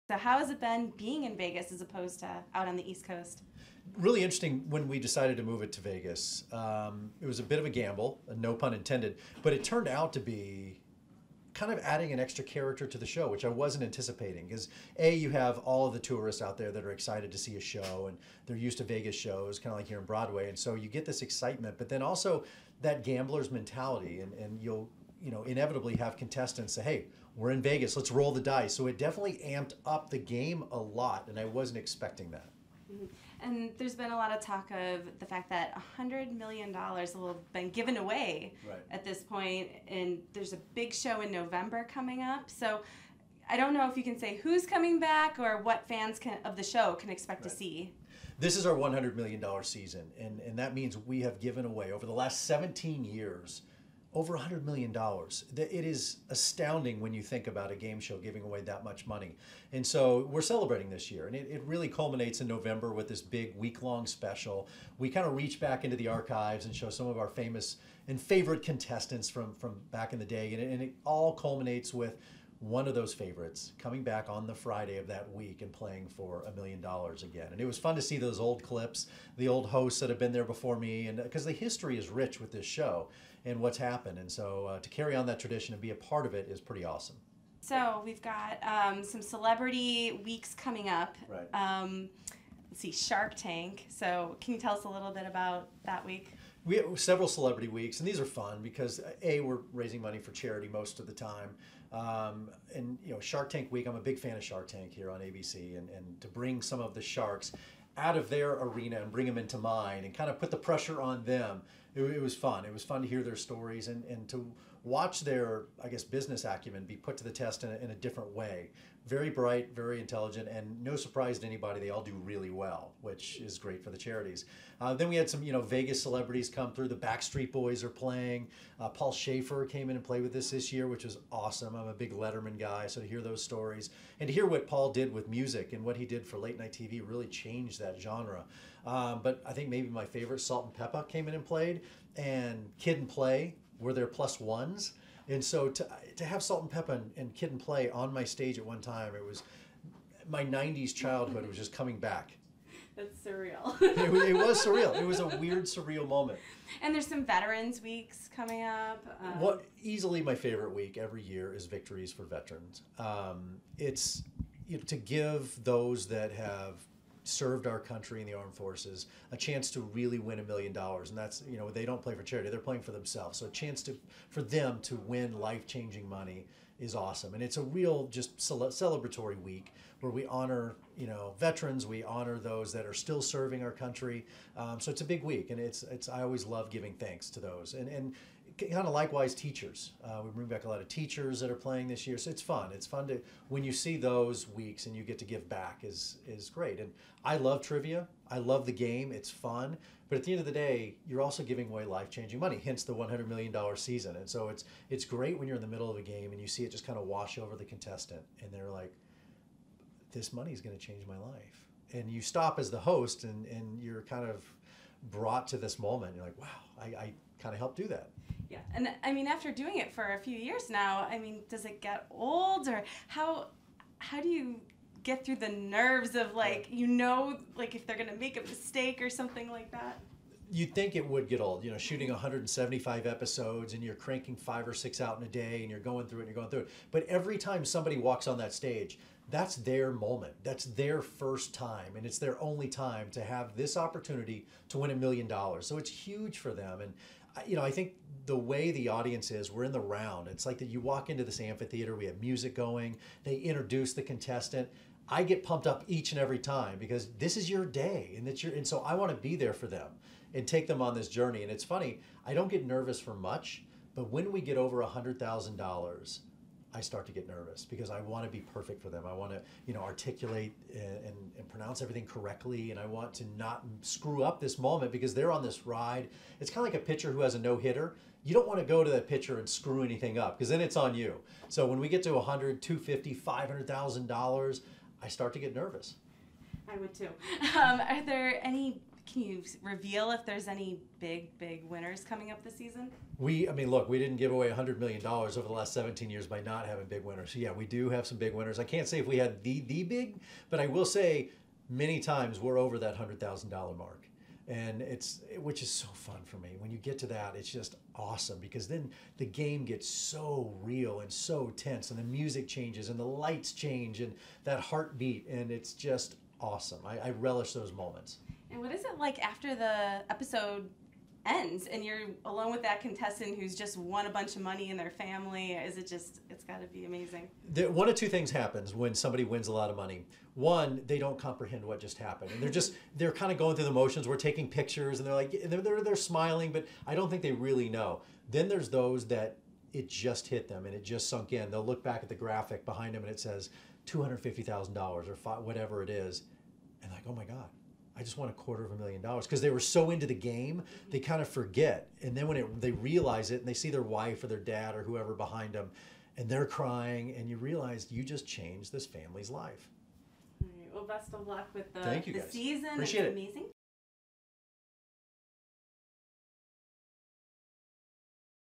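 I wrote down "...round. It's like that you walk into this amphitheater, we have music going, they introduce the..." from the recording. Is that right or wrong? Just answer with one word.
right.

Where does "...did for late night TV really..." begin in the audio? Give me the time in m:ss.
2:16.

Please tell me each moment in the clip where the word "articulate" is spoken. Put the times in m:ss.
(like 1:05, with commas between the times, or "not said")
4:29.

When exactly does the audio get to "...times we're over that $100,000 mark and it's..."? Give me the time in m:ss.
5:01.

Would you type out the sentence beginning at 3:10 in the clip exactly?
Uh, we bring back a lot of teachers that are playing this year, so it's fun.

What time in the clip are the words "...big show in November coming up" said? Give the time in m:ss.
0:40.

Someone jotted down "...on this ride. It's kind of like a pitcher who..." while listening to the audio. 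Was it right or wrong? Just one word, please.
right.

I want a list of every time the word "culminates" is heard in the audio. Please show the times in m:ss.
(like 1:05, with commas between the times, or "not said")
1:01, 1:11.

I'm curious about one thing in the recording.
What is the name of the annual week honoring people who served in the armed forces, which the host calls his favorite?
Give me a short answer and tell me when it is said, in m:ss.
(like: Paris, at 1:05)
Victories for Veterans, at 2:41.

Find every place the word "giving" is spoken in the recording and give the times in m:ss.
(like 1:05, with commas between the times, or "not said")
0:58, 3:06, 3:21.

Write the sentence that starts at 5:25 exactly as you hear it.
Is it just, it's got to be amazing?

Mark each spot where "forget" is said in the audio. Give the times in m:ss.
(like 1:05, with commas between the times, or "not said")
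5:51.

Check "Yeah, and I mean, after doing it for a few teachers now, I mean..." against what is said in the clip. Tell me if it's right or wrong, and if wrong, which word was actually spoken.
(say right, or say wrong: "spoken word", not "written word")
wrong: "years", not "teachers".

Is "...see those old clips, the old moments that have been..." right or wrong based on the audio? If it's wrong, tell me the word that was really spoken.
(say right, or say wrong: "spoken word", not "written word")
wrong: "hosts", not "moments".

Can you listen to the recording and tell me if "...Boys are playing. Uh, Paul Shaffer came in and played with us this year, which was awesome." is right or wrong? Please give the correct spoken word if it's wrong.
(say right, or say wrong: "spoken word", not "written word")
right.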